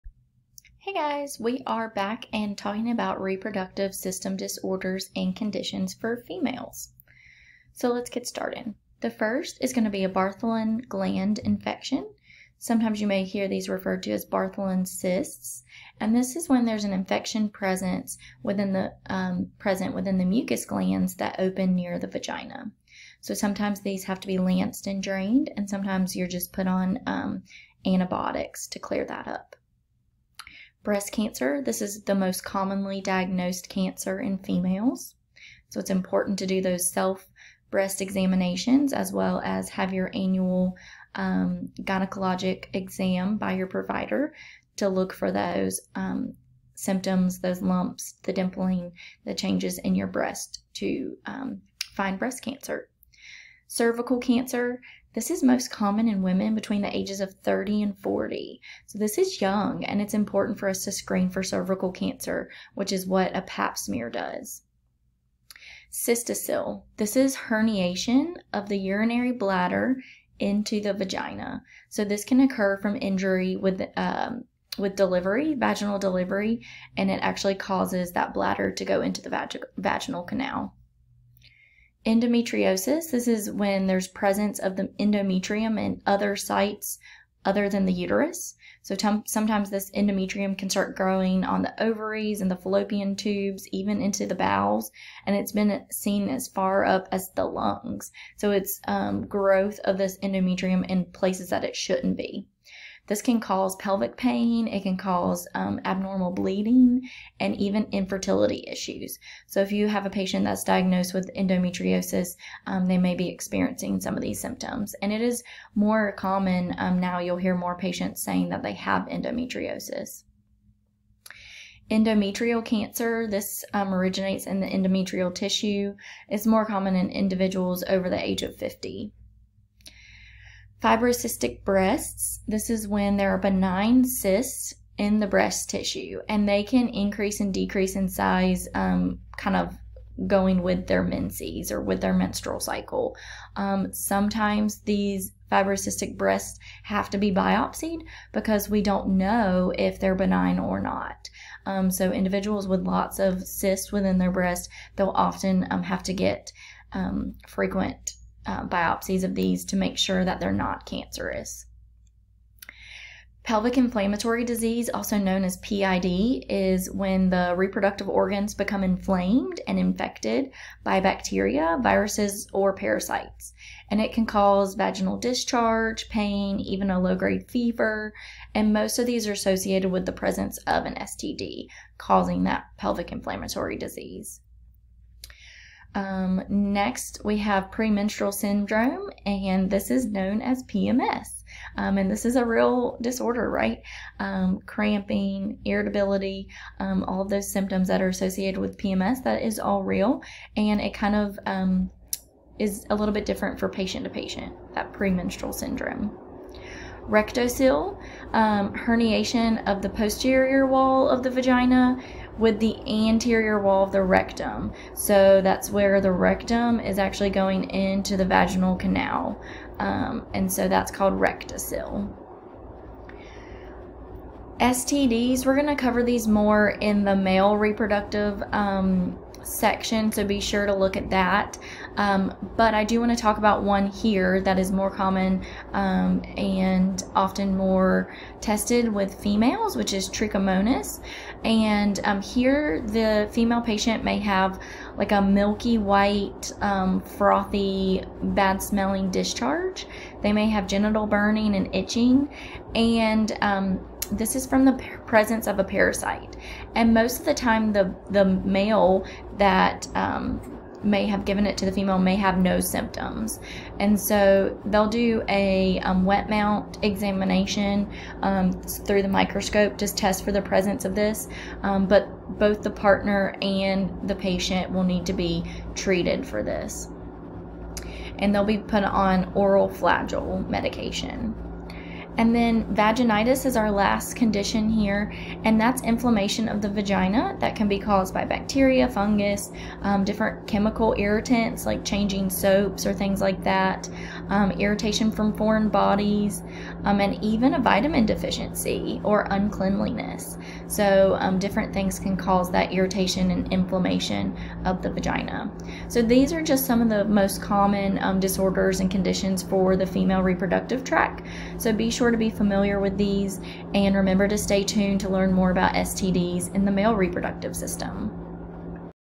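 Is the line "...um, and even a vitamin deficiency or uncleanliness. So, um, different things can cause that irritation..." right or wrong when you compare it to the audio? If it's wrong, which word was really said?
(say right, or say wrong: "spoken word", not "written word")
right.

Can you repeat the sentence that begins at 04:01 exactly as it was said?
And um, here, the female patient may have like a milky white, um, frothy, bad smelling discharge.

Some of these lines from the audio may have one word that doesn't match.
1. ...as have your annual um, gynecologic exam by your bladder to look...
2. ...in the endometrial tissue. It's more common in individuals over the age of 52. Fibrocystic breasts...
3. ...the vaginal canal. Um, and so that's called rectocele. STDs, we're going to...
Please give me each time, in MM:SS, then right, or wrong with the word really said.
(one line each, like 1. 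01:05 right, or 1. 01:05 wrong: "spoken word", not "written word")
1. 00:39 wrong: "provider", not "bladder"
2. 02:04 wrong: "50", not "52"
3. 03:38 right.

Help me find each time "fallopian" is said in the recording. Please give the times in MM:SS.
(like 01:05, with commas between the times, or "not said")
01:32.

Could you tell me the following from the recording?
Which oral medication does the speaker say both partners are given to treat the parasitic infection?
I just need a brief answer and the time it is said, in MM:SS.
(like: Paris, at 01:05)
Flagyl, at 04:39.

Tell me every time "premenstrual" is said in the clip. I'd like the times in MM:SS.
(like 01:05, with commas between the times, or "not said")
03:07, 03:24.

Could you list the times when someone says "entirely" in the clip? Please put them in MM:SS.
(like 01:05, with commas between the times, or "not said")
not said.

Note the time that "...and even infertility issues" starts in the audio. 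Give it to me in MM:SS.
01:47.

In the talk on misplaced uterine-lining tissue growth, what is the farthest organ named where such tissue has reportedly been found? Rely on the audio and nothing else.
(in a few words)
lungs.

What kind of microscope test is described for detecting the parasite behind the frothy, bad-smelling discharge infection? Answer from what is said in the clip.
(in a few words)
wet mount examination.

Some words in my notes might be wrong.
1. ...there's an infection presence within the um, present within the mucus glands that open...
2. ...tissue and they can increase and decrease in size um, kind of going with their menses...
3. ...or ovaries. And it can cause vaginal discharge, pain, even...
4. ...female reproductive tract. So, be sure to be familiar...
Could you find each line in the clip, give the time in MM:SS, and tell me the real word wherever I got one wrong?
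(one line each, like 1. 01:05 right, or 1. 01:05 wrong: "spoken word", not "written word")
1. 00:16 right
2. 02:15 right
3. 02:52 wrong: "parasites", not "ovaries"
4. 05:09 right.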